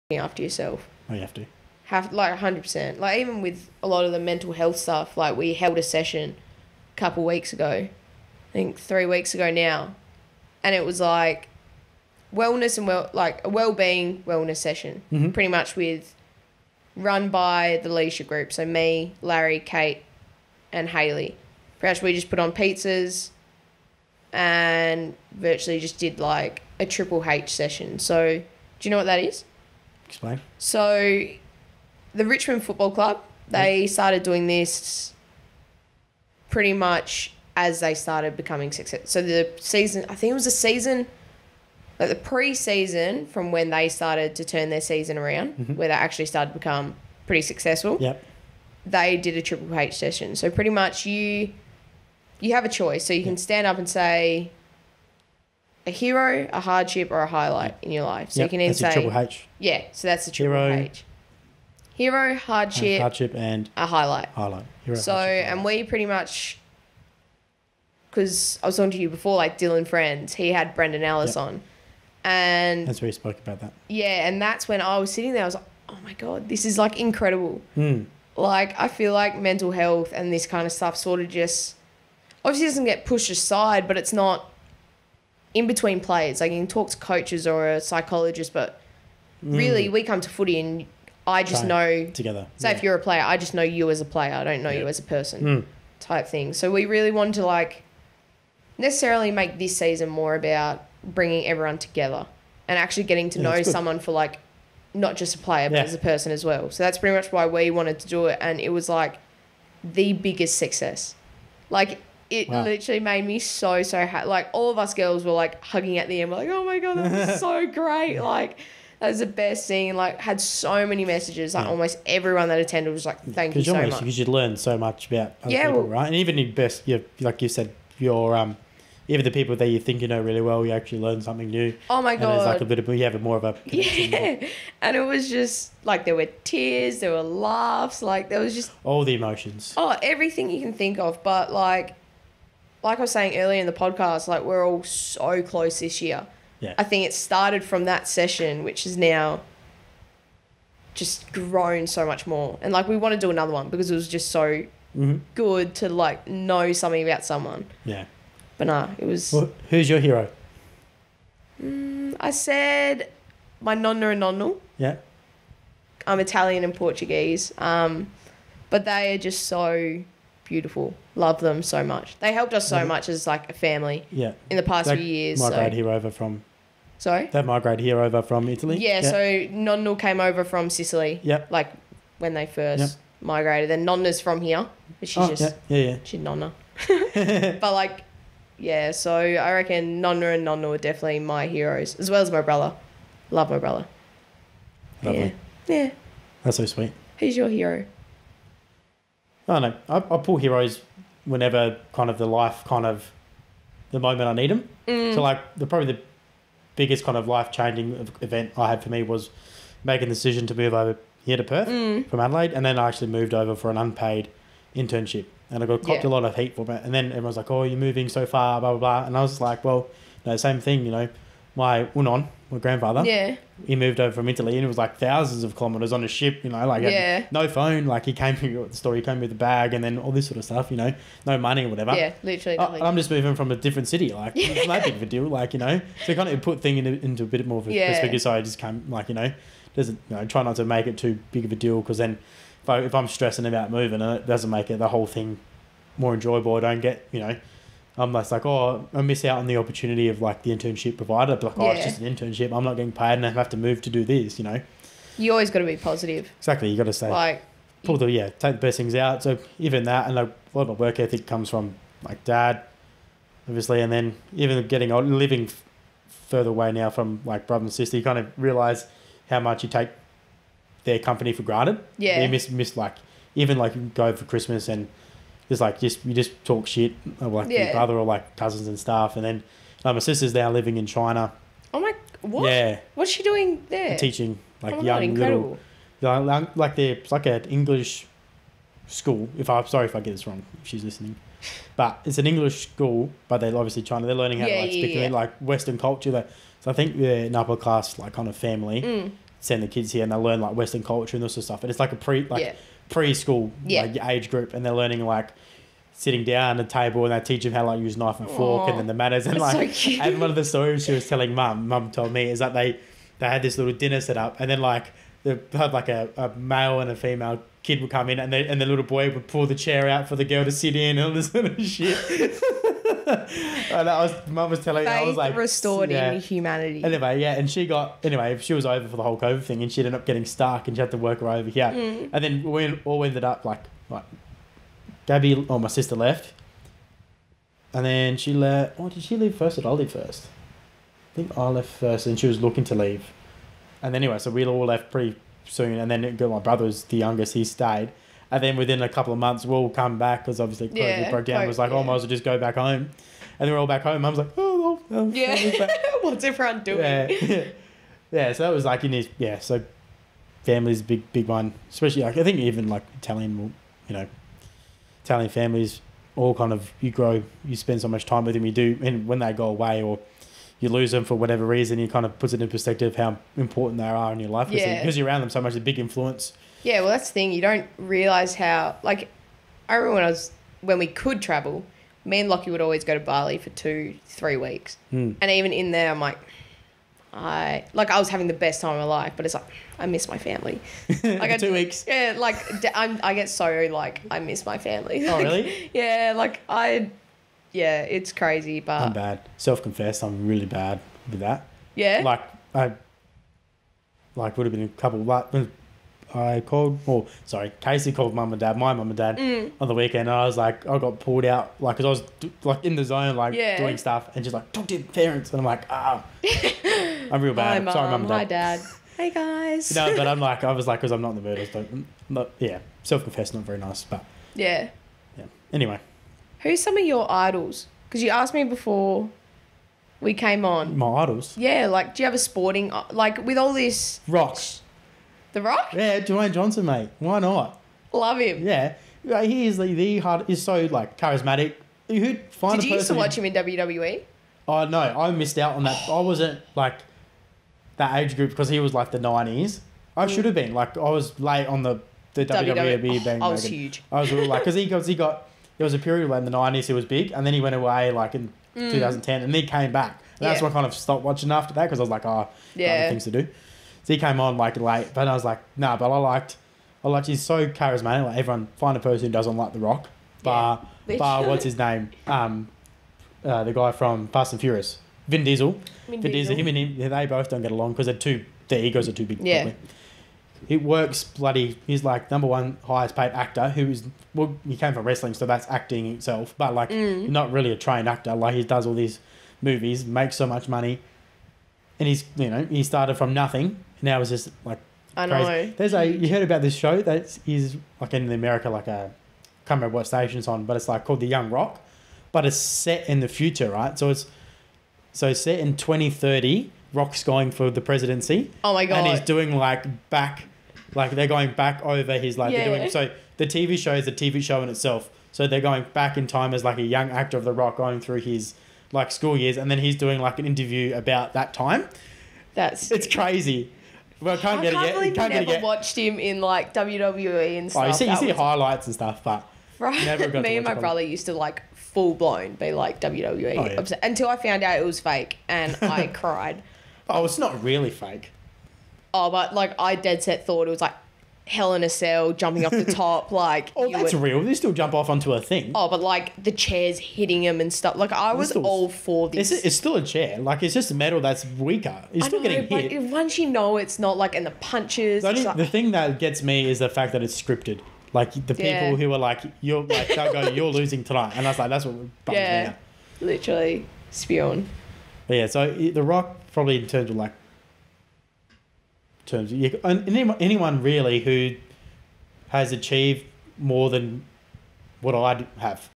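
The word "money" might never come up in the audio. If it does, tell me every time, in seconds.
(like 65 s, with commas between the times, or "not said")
231 s, 490 s.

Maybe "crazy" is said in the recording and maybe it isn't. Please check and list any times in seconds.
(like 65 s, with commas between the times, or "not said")
398 s, 495 s, 522 s.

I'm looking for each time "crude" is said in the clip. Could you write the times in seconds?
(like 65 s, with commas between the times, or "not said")
not said.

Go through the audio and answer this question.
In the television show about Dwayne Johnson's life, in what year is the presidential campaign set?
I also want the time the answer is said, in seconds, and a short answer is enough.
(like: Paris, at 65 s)
2030, at 505 s.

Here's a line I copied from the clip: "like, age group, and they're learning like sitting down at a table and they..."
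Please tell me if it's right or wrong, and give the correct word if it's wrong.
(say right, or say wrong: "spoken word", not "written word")
right.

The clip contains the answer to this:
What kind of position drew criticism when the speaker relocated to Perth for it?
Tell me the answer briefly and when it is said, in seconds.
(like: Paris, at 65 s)
unpaid internship, at 213 s.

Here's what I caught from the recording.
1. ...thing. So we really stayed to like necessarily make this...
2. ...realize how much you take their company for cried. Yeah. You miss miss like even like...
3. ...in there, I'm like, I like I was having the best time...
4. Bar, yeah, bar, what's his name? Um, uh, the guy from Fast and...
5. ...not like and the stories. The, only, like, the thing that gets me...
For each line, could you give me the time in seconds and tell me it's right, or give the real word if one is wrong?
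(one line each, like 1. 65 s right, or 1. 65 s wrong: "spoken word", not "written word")
1. 96 s wrong: "wanted", not "stayed"
2. 268 s wrong: "granted", not "cried"
3. 385 s right
4. 470 s right
5. 553 s wrong: "punches", not "stories".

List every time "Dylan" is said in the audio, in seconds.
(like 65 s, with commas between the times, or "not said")
69 s.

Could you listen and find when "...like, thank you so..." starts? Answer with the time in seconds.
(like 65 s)
123 s.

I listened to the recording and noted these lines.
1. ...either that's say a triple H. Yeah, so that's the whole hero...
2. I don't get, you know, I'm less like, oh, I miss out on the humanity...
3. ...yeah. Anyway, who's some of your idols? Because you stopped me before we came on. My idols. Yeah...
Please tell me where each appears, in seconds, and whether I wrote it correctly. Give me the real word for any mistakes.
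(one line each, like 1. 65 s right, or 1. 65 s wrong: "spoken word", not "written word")
1. 58 s wrong: "triple", not "whole"
2. 246 s wrong: "opportunity", not "humanity"
3. 425 s wrong: "asked", not "stopped".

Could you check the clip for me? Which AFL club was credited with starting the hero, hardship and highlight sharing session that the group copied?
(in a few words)
Richmond Football Club.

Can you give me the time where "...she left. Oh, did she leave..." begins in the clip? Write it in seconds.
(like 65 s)
338 s.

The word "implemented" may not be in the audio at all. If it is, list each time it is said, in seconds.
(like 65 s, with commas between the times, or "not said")
not said.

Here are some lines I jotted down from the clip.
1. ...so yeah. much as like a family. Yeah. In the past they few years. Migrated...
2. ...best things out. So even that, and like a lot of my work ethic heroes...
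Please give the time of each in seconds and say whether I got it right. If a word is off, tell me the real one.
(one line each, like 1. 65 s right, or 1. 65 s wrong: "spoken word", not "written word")
1. 172 s right
2. 258 s wrong: "comes", not "heroes".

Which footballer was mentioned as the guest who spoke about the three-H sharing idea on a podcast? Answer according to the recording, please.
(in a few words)
Brandon Ellis.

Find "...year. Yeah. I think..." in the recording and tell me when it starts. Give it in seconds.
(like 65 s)
146 s.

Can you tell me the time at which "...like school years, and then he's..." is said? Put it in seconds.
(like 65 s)
518 s.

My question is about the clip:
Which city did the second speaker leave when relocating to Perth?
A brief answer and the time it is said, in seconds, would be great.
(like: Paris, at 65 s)
Adelaide, at 212 s.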